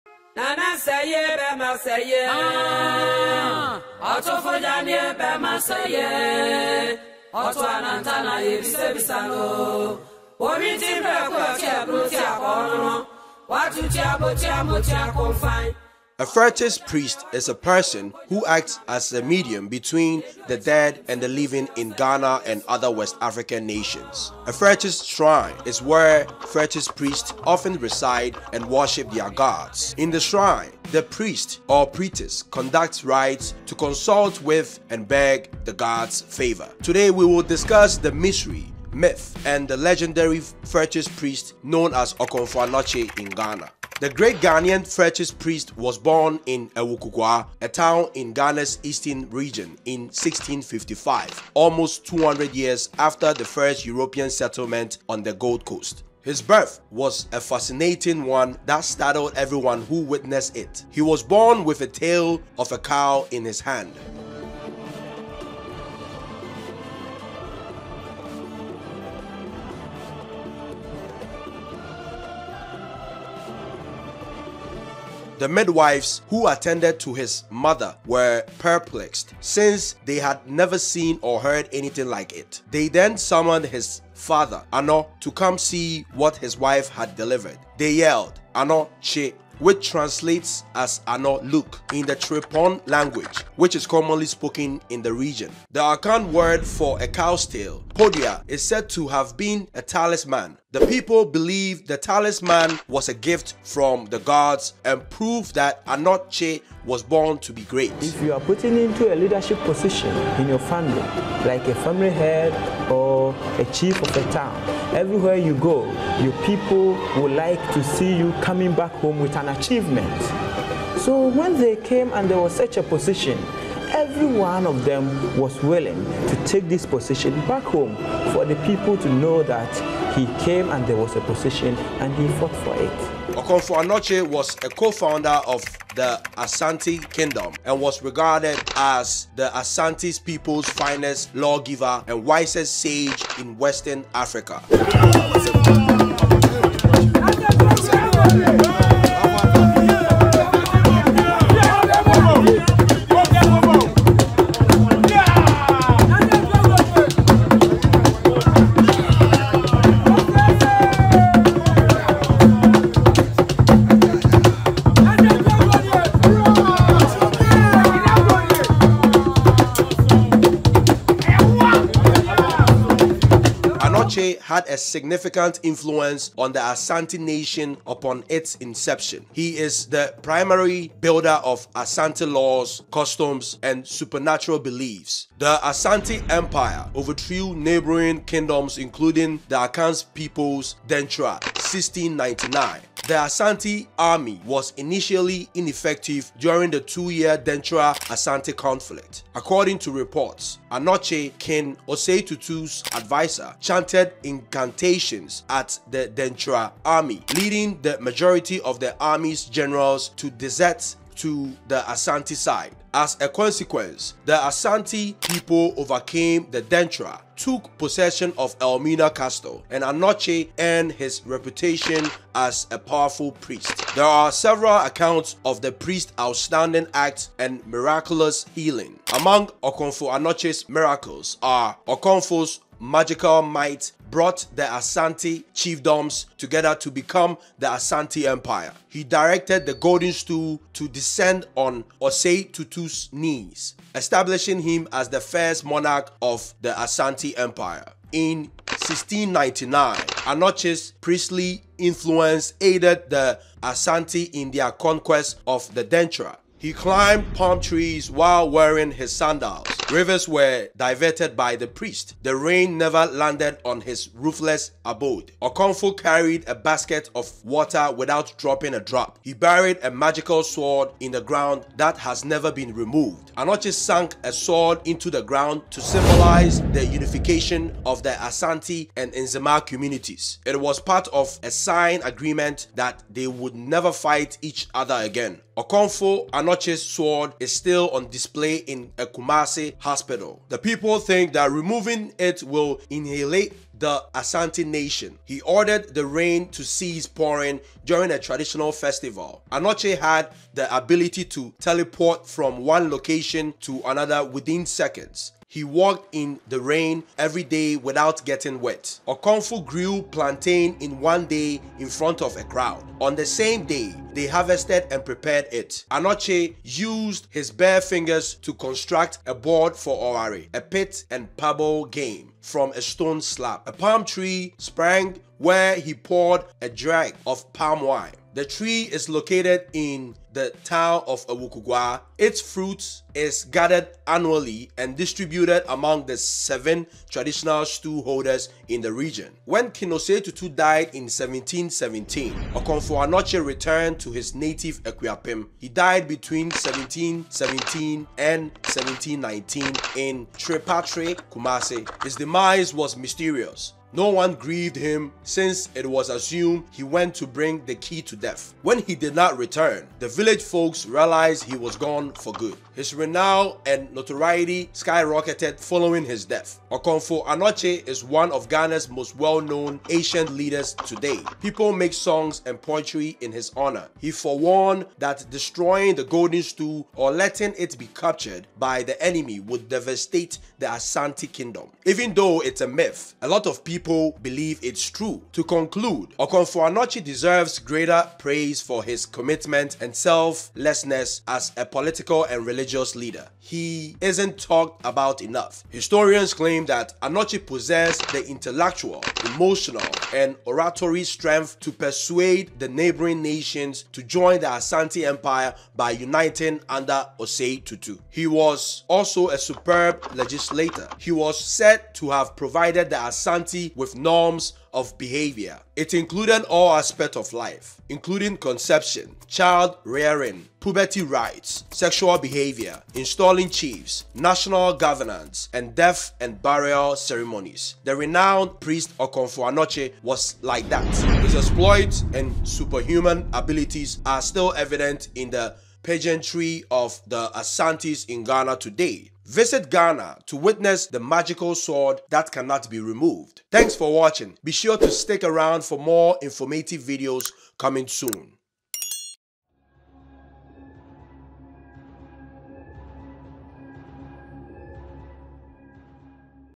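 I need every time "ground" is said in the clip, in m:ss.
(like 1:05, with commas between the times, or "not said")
4:31, 4:35.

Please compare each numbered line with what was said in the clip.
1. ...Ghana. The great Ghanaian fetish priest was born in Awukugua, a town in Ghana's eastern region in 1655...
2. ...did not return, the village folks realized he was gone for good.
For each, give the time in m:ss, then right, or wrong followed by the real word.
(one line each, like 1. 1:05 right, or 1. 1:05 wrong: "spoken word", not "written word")
1. 0:43 right
2. 5:58 right.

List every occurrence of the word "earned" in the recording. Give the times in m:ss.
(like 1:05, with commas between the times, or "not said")
3:40.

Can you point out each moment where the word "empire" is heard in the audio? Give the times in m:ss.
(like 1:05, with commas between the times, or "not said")
3:06, 3:58, 4:07, 6:45.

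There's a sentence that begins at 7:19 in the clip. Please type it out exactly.
Visit Ghana to witness the magical sword that cannot be removed.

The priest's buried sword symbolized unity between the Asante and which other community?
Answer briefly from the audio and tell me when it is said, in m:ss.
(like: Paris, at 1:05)
Nzema, at 4:39.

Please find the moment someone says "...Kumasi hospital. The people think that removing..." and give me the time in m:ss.
4:49.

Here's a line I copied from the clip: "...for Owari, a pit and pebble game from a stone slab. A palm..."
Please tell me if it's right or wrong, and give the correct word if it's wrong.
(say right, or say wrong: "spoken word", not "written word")
right.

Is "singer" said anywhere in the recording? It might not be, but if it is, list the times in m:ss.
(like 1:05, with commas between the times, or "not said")
not said.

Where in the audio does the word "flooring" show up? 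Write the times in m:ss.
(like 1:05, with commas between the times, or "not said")
not said.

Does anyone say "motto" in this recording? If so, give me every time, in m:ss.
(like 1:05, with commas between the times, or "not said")
not said.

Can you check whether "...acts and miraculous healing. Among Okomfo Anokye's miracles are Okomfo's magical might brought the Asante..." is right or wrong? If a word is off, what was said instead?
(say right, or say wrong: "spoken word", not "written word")
right.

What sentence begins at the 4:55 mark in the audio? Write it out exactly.
He ordered the rain to cease pouring during a traditional festival.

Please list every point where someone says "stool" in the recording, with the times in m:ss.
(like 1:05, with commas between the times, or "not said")
4:00, 6:16.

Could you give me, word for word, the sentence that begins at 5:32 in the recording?
Its fruit is gathered annually and distributed among the seven traditional stew holders in the region.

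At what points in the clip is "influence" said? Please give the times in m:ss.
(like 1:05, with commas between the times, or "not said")
2:55, 4:11.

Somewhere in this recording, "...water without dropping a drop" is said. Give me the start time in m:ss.
4:27.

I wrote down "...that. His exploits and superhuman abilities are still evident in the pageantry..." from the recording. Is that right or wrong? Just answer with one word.
right.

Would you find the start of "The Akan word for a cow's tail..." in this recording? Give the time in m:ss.
1:35.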